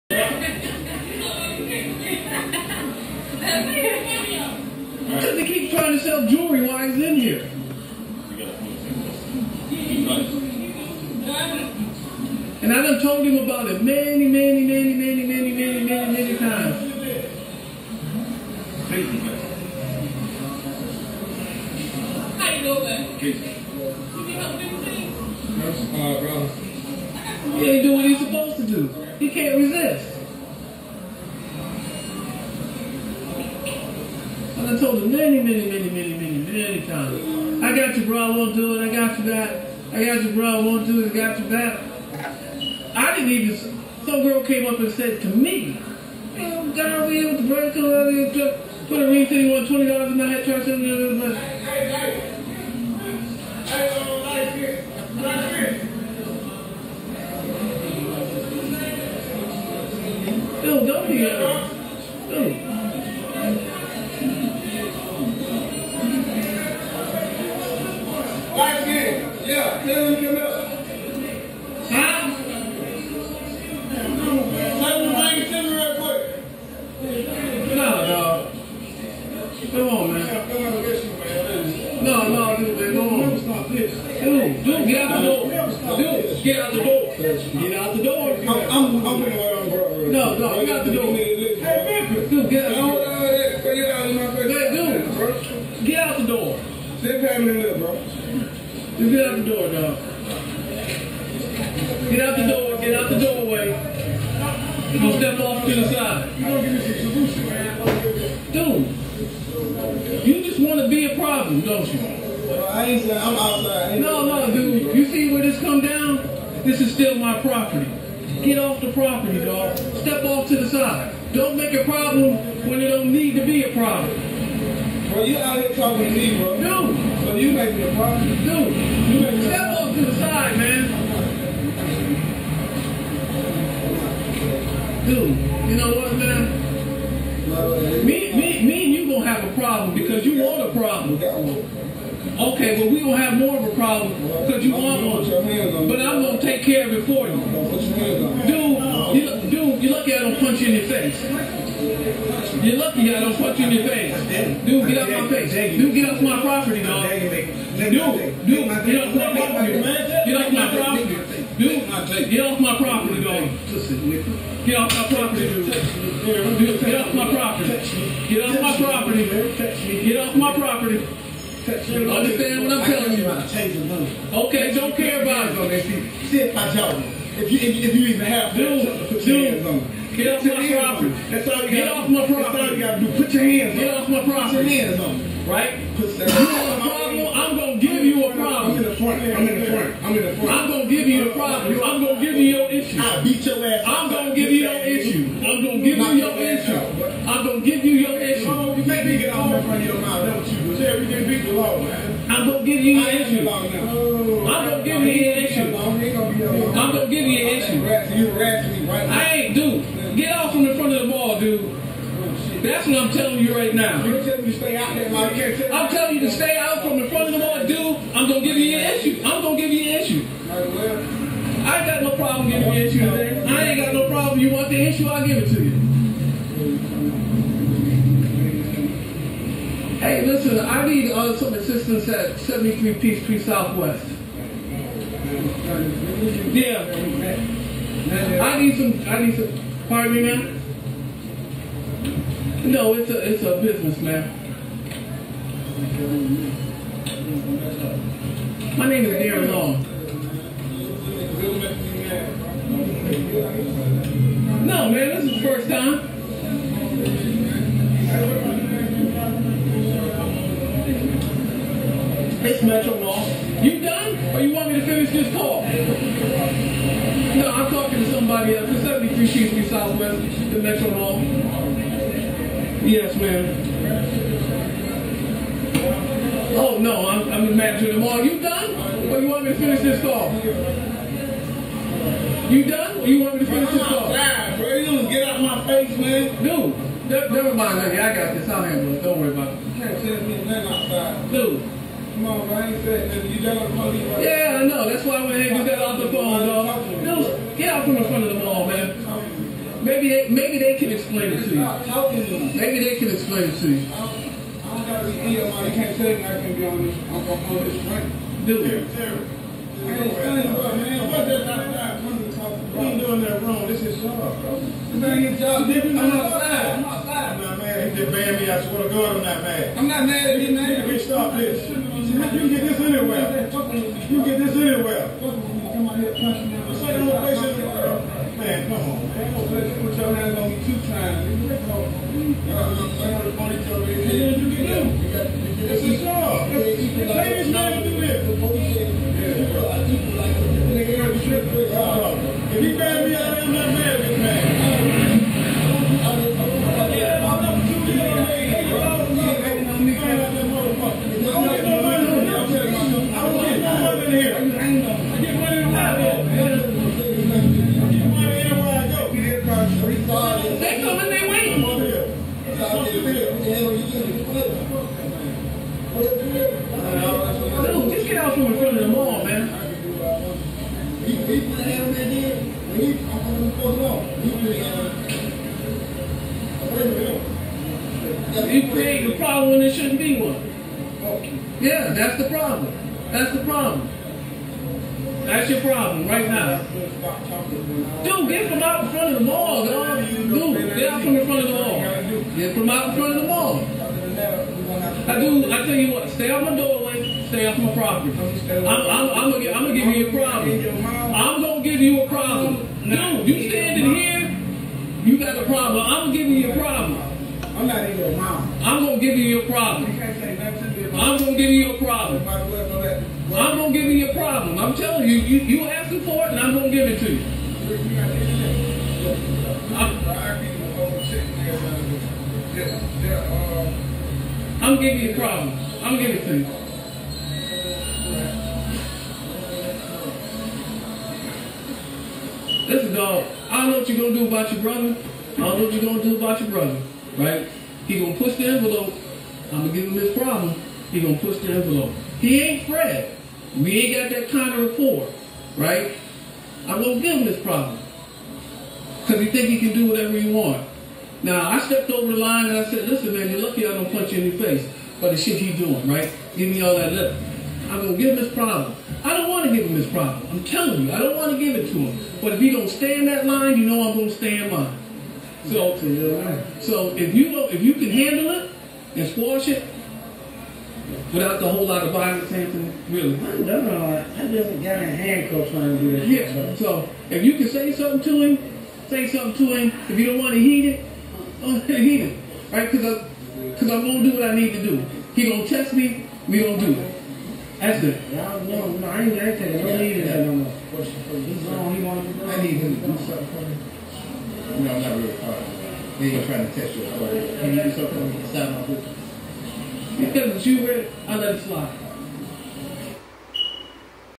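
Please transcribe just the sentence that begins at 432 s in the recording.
Listen, dog, I don't know what you're going to do about your brother.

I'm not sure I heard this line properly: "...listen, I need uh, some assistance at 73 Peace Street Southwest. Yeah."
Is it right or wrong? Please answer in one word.
right.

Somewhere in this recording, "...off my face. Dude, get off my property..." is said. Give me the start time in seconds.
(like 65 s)
154 s.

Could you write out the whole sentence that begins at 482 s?
Cause I, cause I'm gonna do what I need to do.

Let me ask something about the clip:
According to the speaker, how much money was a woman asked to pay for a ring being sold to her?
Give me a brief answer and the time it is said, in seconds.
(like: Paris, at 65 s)
$20, at 49 s.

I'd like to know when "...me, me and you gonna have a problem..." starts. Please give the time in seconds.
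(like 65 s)
138 s.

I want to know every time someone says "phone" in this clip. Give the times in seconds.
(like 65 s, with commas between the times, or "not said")
296 s.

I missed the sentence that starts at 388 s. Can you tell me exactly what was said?
Dude, get them out in front of the mall.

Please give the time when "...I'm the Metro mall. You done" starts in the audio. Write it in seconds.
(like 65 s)
277 s.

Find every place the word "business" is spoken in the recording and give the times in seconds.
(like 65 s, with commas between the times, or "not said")
243 s.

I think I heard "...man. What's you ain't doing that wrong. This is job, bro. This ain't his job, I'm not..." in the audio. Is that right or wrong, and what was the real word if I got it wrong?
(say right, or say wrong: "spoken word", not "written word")
right.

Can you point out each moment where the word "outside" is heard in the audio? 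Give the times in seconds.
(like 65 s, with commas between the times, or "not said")
113 s, 290 s.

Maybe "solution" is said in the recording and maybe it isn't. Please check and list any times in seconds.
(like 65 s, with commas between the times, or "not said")
107 s.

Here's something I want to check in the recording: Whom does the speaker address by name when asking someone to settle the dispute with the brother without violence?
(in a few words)
Anthony.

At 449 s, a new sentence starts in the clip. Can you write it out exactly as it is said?
Because he think he can do whatever he want.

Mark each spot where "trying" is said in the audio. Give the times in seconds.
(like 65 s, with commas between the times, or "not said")
5 s, 475 s, 496 s.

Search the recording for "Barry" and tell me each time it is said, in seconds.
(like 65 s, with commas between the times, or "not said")
not said.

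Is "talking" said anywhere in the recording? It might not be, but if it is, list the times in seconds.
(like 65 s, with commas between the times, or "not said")
125 s, 267 s.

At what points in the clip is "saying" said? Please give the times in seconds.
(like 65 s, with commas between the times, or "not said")
113 s, 332 s.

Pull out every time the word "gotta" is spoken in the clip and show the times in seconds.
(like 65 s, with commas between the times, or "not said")
182 s, 304 s.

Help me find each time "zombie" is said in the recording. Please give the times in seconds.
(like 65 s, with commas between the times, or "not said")
not said.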